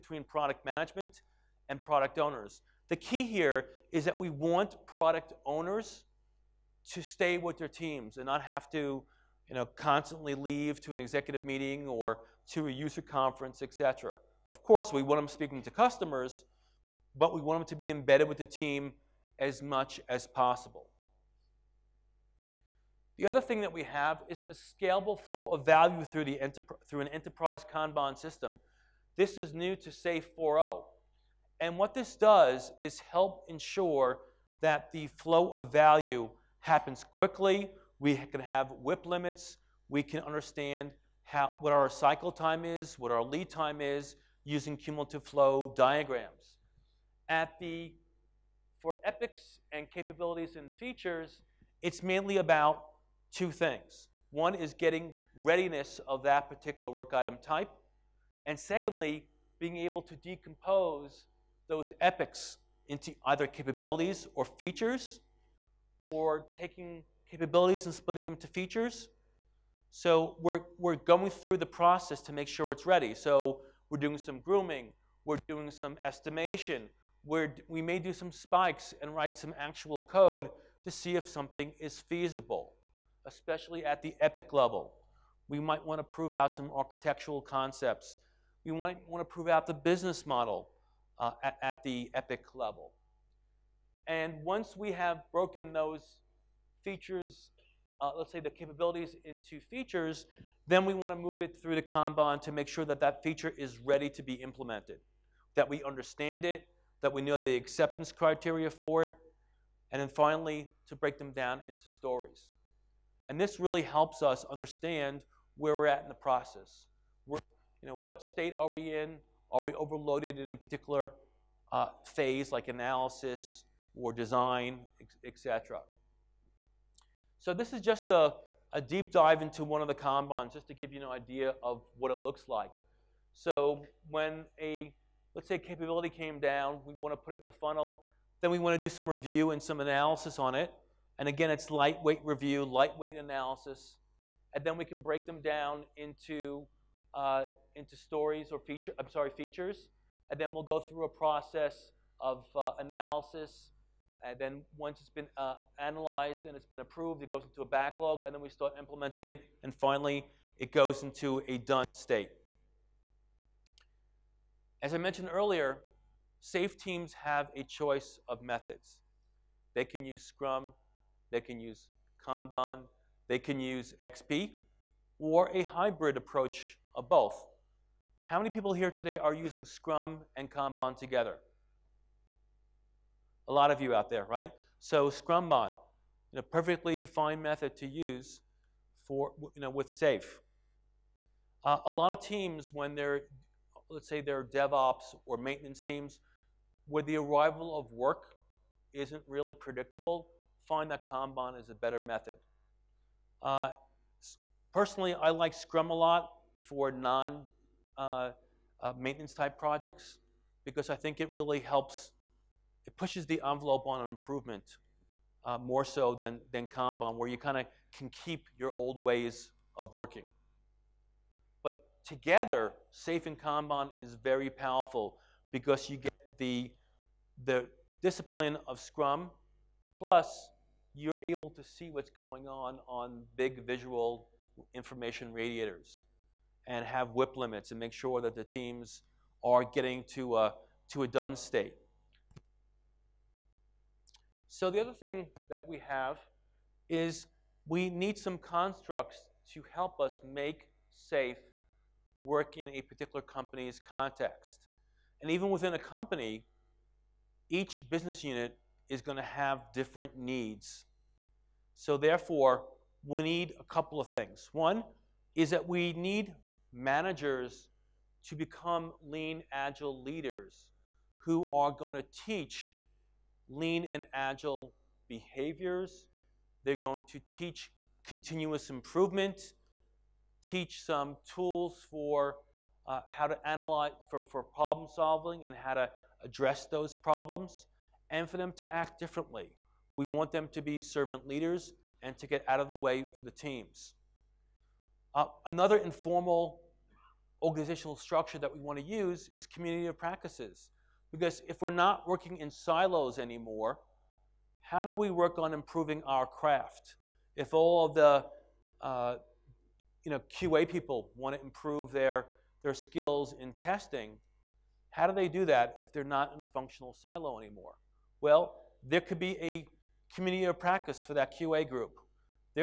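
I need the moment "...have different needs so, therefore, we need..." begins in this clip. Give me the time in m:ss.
4:19.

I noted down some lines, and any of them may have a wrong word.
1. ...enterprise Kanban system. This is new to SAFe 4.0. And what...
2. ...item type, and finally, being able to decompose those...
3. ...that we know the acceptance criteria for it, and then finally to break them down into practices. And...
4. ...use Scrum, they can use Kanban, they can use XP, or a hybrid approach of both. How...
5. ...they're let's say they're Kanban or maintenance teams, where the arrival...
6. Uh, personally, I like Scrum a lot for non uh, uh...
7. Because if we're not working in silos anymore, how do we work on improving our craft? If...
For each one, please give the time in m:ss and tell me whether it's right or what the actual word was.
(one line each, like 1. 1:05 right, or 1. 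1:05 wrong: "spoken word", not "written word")
1. 0:27 right
2. 0:57 wrong: "secondly", not "finally"
3. 1:47 wrong: "stories", not "practices"
4. 2:50 right
5. 3:12 wrong: "DevOps", not "Kanban"
6. 3:23 right
7. 5:01 right.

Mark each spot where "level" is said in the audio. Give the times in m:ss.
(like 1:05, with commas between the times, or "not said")
1:24, 1:32.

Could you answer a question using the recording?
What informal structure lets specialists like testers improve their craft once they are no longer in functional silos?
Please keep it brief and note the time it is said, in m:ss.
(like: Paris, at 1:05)
Community of practice, at 5:20.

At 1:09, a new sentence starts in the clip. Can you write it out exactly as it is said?
So we're, we're going through the process to make sure it's ready.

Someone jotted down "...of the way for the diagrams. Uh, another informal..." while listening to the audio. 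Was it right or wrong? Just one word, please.
wrong.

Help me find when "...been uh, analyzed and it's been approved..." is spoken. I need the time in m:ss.
2:35.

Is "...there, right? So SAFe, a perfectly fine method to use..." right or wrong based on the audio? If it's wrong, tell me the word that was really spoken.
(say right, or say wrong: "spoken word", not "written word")
wrong: "Scrumban", not "SAFe".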